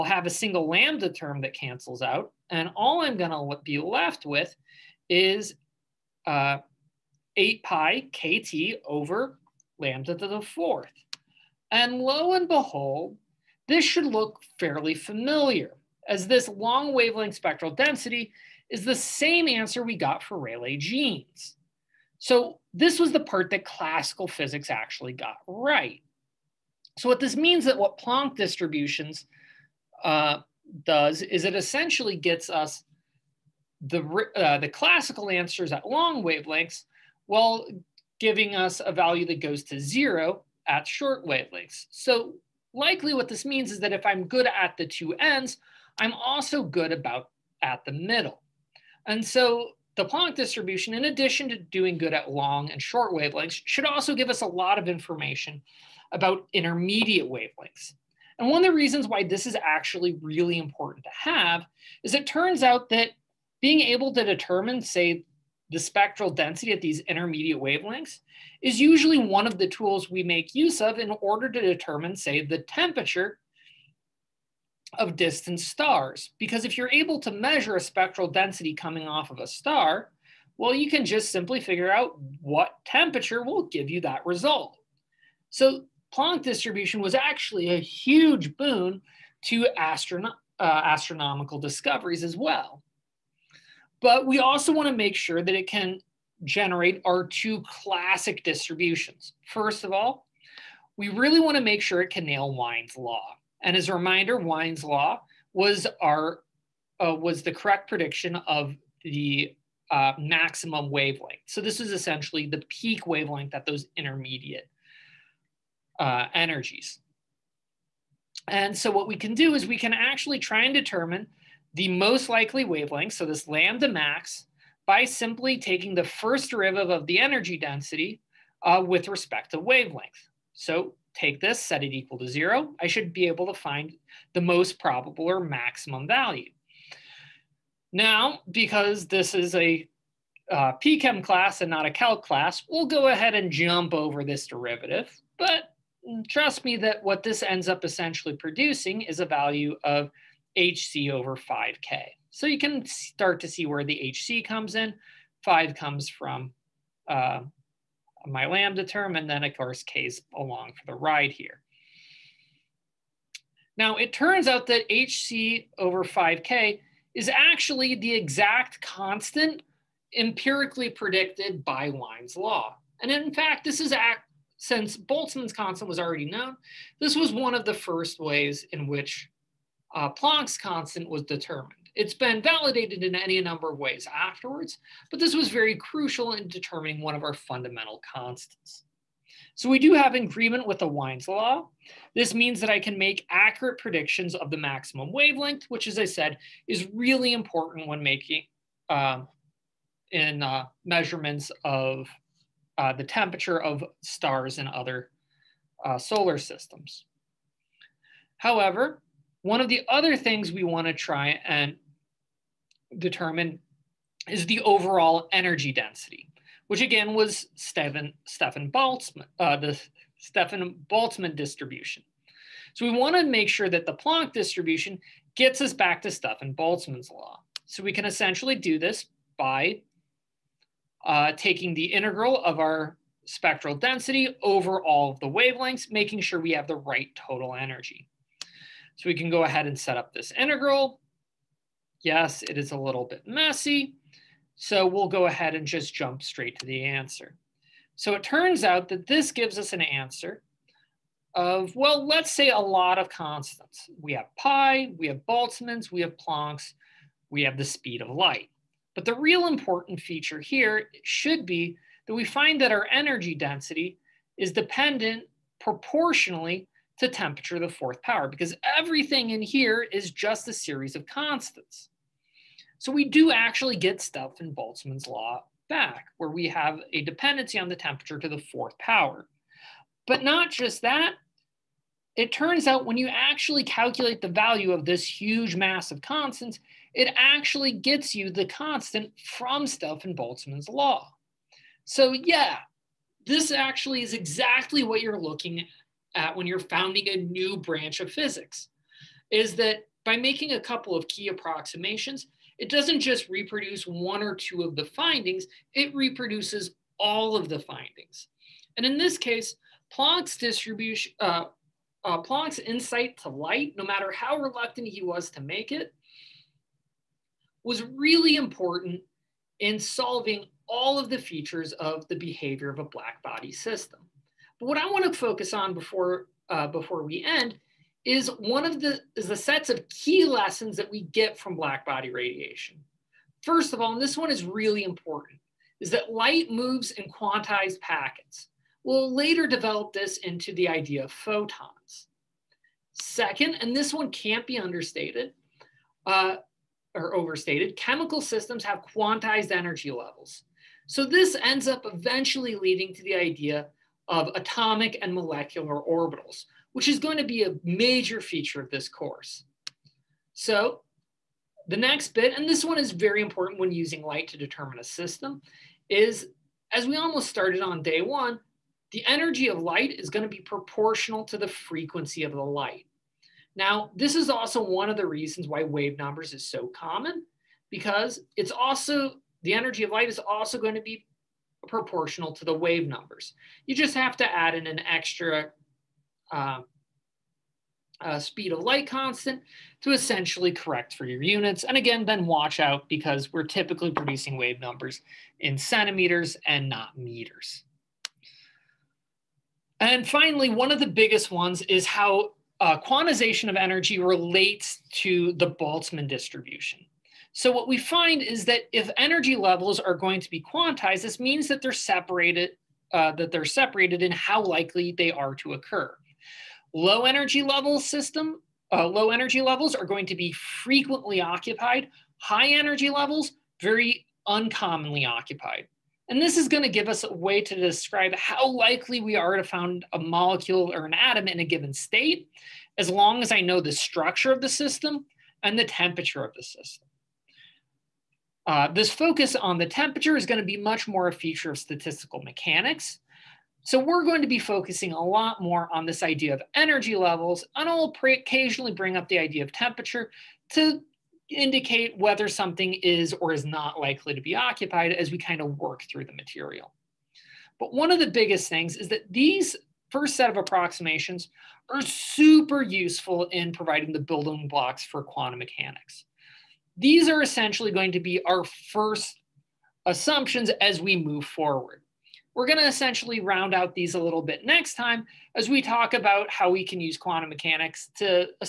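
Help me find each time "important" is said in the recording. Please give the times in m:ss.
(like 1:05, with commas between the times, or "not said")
1:00, 3:17, 4:19, 5:18, 5:34, 6:03.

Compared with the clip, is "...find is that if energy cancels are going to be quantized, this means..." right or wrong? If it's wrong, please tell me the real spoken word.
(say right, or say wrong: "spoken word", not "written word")
wrong: "levels", not "cancels".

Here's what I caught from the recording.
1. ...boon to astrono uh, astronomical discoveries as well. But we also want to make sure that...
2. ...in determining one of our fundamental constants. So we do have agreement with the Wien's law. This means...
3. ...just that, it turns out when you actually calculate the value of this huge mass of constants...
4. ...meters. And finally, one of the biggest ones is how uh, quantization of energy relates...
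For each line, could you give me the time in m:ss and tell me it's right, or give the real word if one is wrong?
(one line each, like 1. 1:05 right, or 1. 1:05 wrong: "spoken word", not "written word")
1. 1:28 right
2. 3:06 right
3. 4:40 right
4. 6:36 right.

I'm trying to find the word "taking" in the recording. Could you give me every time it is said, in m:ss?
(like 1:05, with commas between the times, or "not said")
2:05, 3:51.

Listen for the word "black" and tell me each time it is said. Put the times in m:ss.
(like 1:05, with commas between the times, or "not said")
5:22, 5:31.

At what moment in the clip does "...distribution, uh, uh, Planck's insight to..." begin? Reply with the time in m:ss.
5:10.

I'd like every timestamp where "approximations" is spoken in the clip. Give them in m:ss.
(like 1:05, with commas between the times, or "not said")
5:01, 7:40.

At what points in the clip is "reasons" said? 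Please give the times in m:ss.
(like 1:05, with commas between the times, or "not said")
0:58, 6:15.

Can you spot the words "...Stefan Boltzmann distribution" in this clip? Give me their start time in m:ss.
3:40.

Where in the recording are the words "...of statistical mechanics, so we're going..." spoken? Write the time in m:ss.
7:21.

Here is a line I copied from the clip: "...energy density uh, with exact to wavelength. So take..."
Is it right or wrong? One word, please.
wrong.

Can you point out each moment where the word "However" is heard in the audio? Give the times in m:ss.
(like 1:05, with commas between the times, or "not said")
3:28.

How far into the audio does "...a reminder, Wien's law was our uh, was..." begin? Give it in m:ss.
1:43.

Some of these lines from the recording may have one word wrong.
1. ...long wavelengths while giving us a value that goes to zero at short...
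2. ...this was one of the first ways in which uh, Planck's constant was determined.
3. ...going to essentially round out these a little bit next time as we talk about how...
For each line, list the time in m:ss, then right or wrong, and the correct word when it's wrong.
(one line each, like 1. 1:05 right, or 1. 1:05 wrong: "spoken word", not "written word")
1. 0:35 right
2. 2:56 right
3. 7:52 right.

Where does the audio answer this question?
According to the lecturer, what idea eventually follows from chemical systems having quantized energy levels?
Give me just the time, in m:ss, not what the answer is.
5:54.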